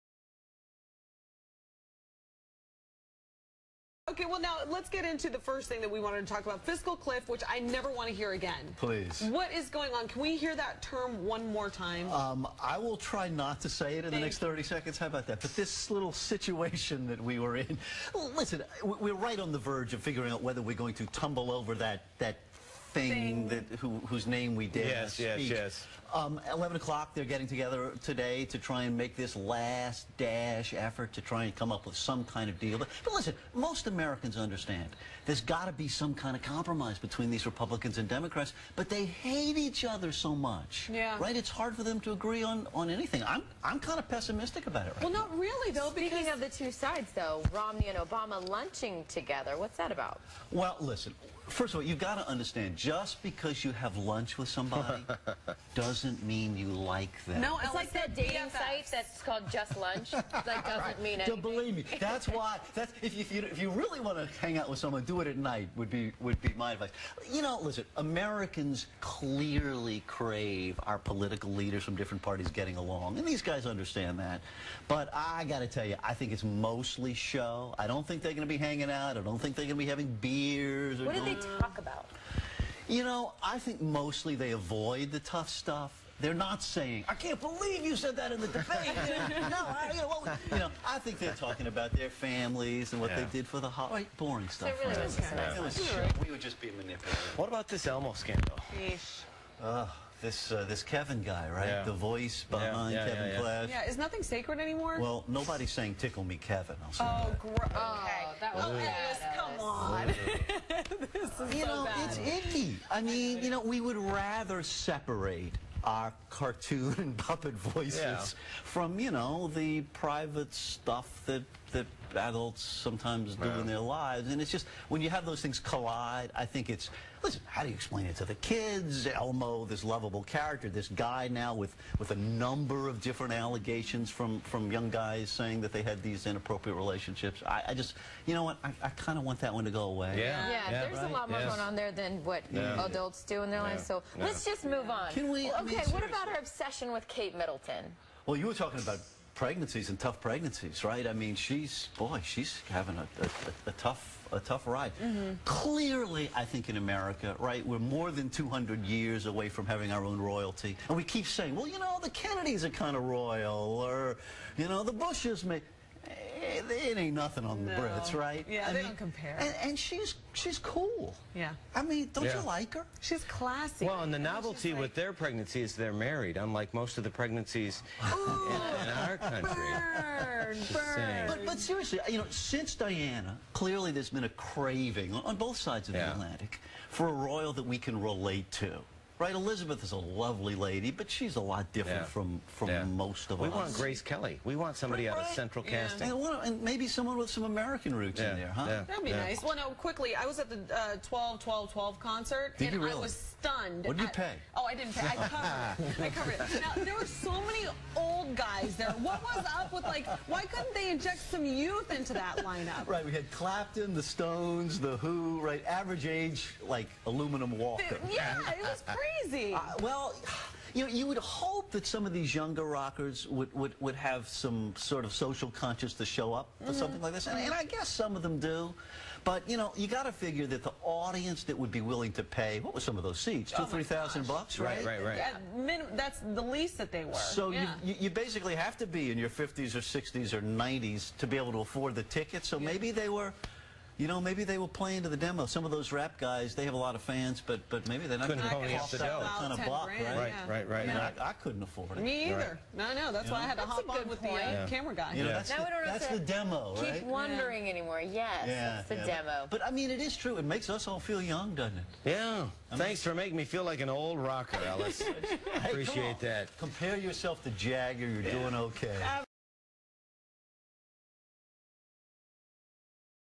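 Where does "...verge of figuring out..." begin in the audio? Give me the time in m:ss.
0:19.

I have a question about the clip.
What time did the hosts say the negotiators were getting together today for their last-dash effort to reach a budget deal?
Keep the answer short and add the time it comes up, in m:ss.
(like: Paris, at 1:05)
11 o'clock, at 0:26.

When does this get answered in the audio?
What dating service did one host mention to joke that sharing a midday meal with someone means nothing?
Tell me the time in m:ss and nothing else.
0:59.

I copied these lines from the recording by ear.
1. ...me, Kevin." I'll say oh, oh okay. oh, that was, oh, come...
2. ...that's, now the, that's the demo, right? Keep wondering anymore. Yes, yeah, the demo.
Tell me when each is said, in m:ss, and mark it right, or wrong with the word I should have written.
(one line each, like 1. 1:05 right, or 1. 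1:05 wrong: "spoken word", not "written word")
1. 1:46 right
2. 4:15 right.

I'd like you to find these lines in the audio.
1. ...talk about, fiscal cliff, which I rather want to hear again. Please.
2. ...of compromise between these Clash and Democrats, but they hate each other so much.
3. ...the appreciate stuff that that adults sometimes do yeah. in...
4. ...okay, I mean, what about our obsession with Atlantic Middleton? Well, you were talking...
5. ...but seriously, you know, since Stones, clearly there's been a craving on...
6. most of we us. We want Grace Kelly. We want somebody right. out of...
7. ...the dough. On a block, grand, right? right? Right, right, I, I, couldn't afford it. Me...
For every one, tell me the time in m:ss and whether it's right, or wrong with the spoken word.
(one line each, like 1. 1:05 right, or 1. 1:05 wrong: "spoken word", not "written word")
1. 0:06 wrong: "never", not "rather"
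2. 0:36 wrong: "Republicans", not "Clash"
3. 1:59 wrong: "private", not "appreciate"
4. 2:25 wrong: "Kate", not "Atlantic"
5. 3:01 wrong: "Diana", not "Stones"
6. 3:12 right
7. 4:08 right.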